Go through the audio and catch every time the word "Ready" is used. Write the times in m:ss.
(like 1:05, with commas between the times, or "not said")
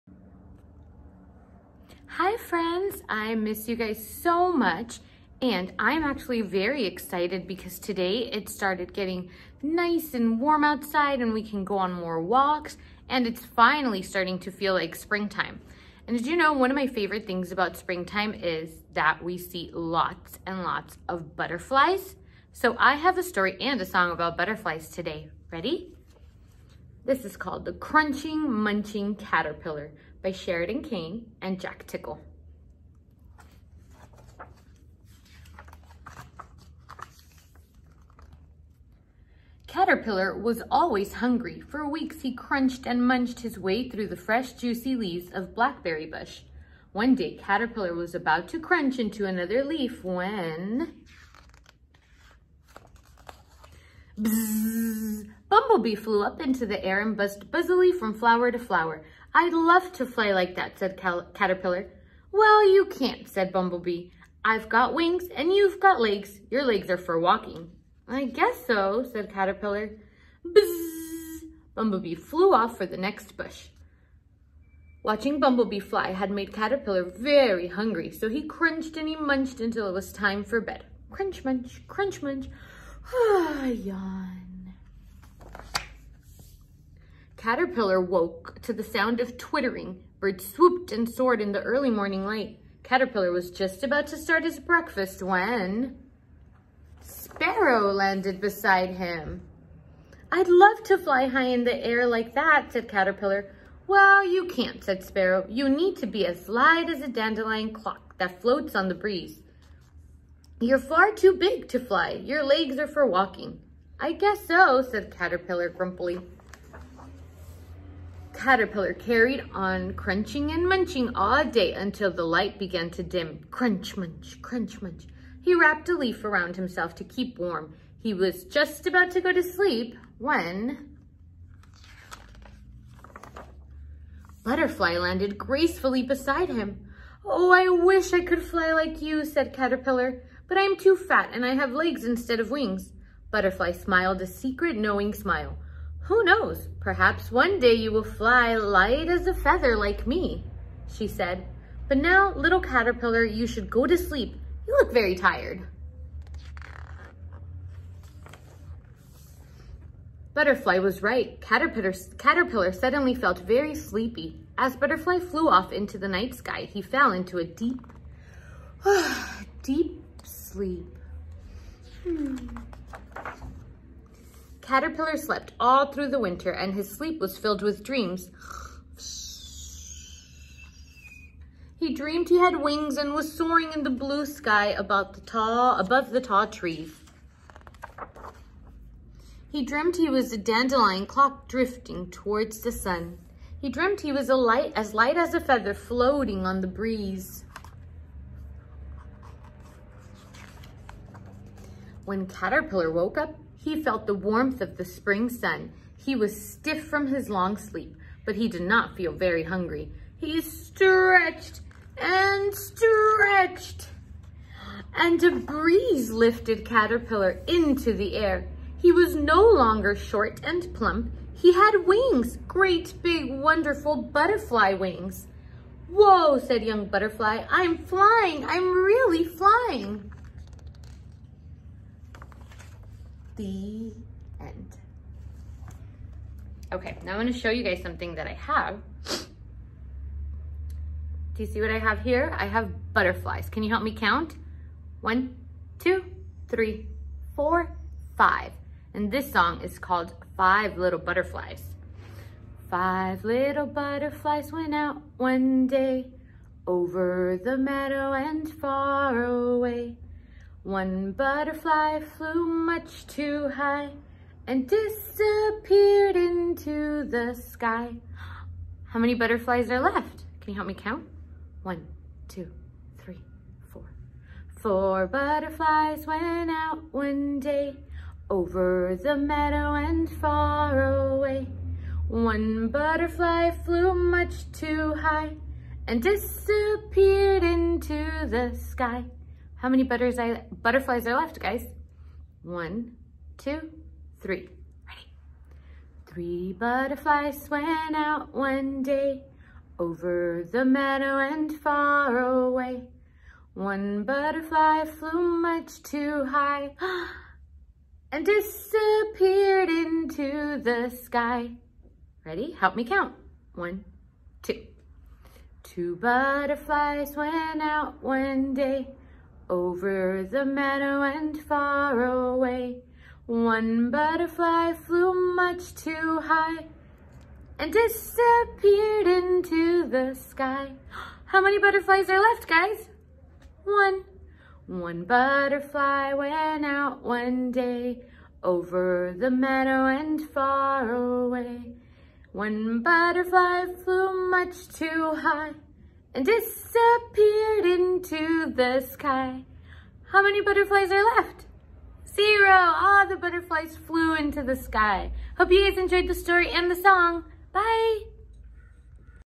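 0:25, 4:54, 5:12.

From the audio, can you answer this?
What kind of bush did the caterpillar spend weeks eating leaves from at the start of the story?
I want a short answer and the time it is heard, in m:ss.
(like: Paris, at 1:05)
Blackberry bush, at 0:45.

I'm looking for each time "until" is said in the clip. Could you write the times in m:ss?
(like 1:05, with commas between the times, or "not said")
1:19, 2:01.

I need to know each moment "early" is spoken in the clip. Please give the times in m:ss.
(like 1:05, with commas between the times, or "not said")
1:31.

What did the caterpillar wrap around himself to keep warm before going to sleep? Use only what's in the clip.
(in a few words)
A leaf.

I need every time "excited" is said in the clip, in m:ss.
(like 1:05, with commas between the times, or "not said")
0:06.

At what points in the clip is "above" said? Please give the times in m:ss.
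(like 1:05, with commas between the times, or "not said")
3:05.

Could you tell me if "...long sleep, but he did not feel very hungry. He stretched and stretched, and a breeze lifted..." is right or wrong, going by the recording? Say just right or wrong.
right.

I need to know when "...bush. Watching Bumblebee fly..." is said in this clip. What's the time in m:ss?
1:13.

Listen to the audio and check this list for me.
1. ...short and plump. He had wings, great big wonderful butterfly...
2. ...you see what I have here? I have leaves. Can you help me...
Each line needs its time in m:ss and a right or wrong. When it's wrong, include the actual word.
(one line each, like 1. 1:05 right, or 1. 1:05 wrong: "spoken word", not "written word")
1. 3:39 right
2. 4:01 wrong: "butterflies", not "leaves".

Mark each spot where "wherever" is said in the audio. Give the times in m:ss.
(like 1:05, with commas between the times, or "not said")
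not said.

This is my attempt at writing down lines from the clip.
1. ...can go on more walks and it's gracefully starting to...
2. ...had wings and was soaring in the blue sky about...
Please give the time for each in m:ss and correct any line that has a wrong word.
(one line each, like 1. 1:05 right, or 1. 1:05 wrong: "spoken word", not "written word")
1. 0:11 wrong: "finally", not "gracefully"
2. 3:02 right.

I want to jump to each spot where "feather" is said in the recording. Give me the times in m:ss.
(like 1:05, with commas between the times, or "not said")
2:29, 3:15.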